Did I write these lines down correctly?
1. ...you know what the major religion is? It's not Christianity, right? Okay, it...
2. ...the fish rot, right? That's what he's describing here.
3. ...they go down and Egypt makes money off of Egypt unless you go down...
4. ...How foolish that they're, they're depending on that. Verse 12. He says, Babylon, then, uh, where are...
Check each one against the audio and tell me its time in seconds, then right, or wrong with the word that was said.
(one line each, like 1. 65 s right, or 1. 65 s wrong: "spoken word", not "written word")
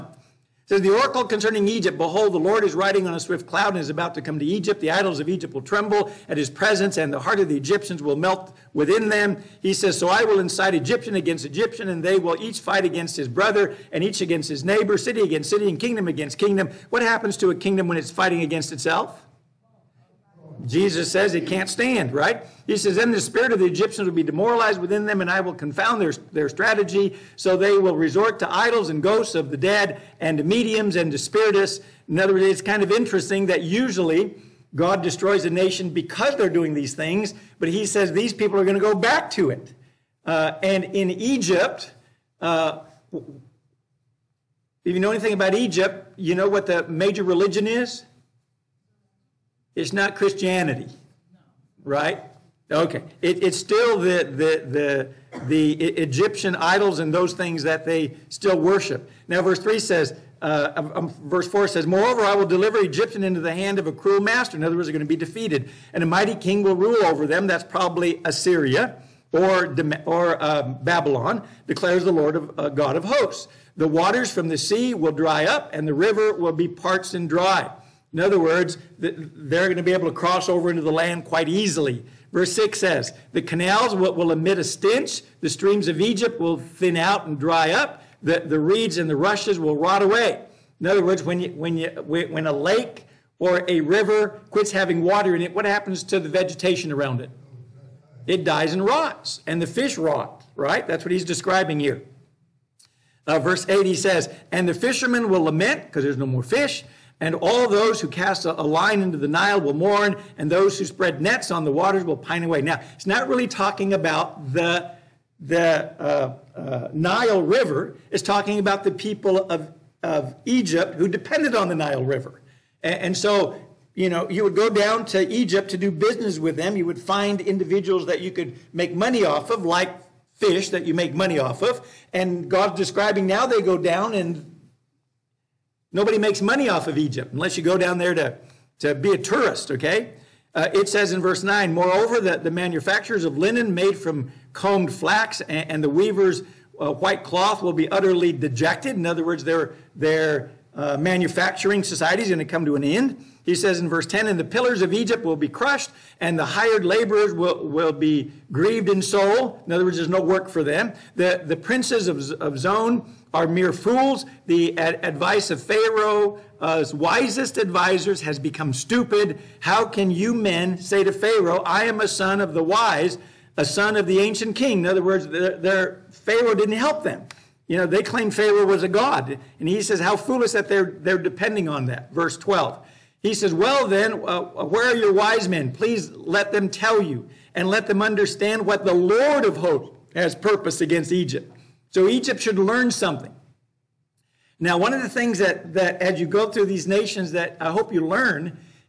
1. 46 s right
2. 99 s right
3. 133 s wrong: "Nobody", not "Egypt"
4. 179 s wrong: "Well", not "Babylon".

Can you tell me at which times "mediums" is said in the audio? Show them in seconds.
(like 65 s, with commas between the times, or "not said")
30 s.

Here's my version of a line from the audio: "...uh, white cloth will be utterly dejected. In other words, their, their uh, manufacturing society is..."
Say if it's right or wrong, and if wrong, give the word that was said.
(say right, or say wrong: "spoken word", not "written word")
right.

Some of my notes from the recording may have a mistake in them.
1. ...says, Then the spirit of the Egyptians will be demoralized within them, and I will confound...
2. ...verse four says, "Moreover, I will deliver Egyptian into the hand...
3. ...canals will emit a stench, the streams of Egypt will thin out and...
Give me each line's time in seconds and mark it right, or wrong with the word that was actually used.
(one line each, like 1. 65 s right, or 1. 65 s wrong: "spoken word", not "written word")
1. 22 s right
2. 61 s right
3. 83 s right.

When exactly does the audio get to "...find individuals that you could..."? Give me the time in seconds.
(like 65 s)
126 s.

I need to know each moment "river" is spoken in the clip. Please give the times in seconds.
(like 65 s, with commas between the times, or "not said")
75 s, 93 s, 117 s, 122 s.